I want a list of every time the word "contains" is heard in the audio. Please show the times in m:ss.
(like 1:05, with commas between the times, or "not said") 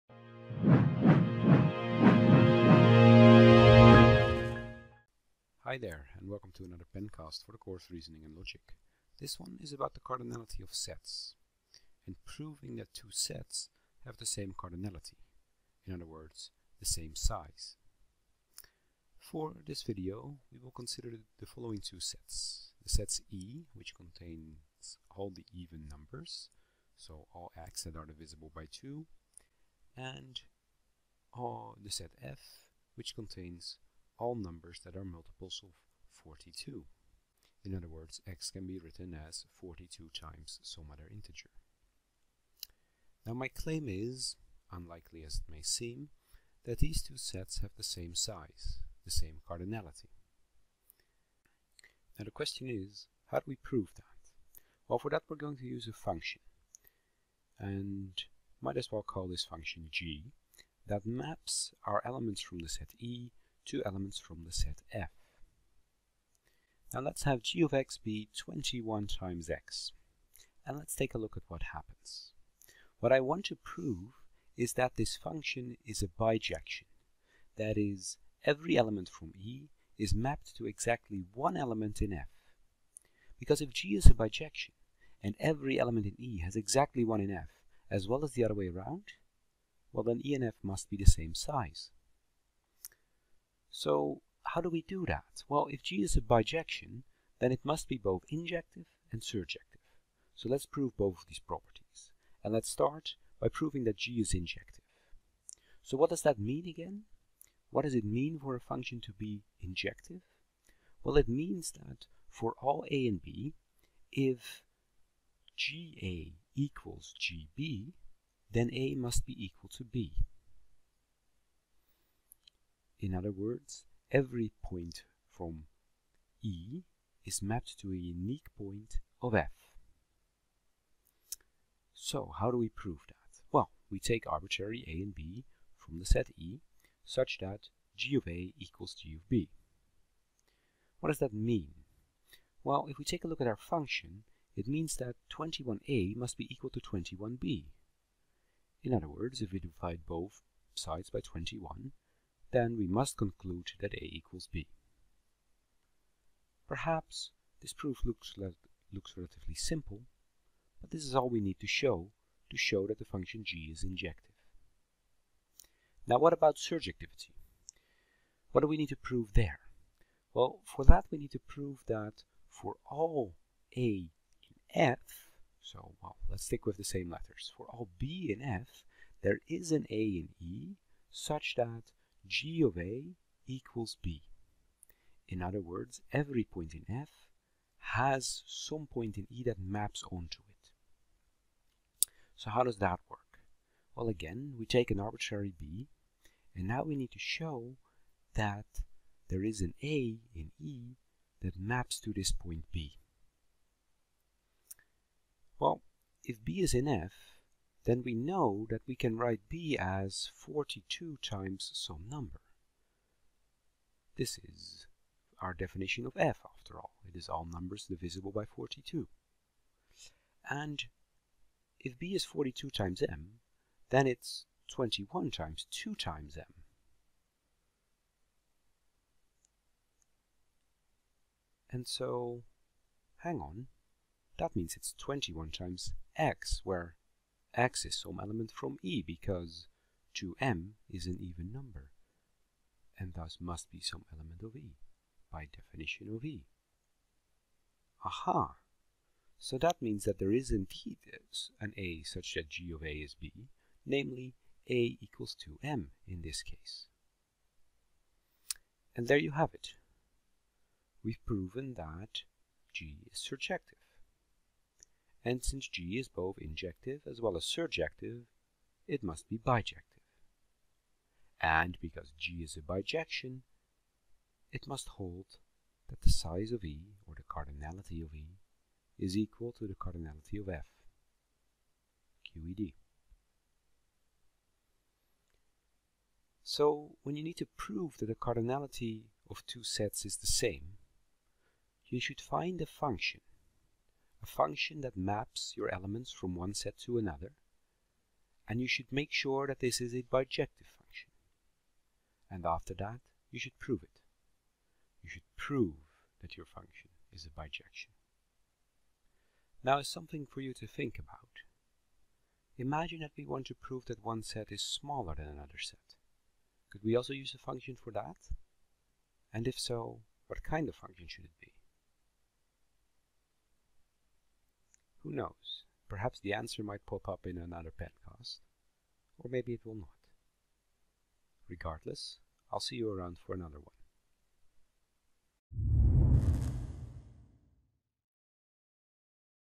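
0:23, 0:33.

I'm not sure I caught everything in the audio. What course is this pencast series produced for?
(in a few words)
Reasoning and Logic.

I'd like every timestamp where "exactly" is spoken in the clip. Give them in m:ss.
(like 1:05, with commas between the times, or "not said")
1:20, 1:26.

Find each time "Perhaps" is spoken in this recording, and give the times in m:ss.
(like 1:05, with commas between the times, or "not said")
2:36, 5:25.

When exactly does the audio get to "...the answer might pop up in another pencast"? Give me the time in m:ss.
5:26.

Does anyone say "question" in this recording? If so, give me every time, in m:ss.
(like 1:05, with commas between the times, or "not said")
0:52.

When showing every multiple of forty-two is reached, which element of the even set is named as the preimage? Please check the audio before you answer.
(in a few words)
2m.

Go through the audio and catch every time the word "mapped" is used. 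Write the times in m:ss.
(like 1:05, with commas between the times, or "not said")
1:20, 2:07.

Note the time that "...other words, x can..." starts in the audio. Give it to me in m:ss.
0:37.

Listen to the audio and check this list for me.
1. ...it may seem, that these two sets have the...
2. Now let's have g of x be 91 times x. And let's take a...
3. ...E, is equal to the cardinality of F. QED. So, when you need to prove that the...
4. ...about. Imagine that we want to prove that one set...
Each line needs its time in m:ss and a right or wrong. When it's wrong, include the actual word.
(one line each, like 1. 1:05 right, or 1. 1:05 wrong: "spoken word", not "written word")
1. 0:45 right
2. 1:06 wrong: "21", not "91"
3. 4:38 right
4. 5:10 right.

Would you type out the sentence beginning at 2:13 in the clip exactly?
Well, we take arbitrary A and B from the set E such that G of A equals G of B.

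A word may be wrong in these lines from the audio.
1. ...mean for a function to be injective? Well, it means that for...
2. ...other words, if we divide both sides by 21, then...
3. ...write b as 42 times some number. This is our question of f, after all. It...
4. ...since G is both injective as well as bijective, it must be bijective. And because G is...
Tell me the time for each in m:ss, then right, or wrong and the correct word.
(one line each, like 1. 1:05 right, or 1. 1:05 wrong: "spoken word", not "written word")
1. 1:48 right
2. 2:28 right
3. 3:29 wrong: "definition", not "question"
4. 4:25 wrong: "surjective", not "bijective".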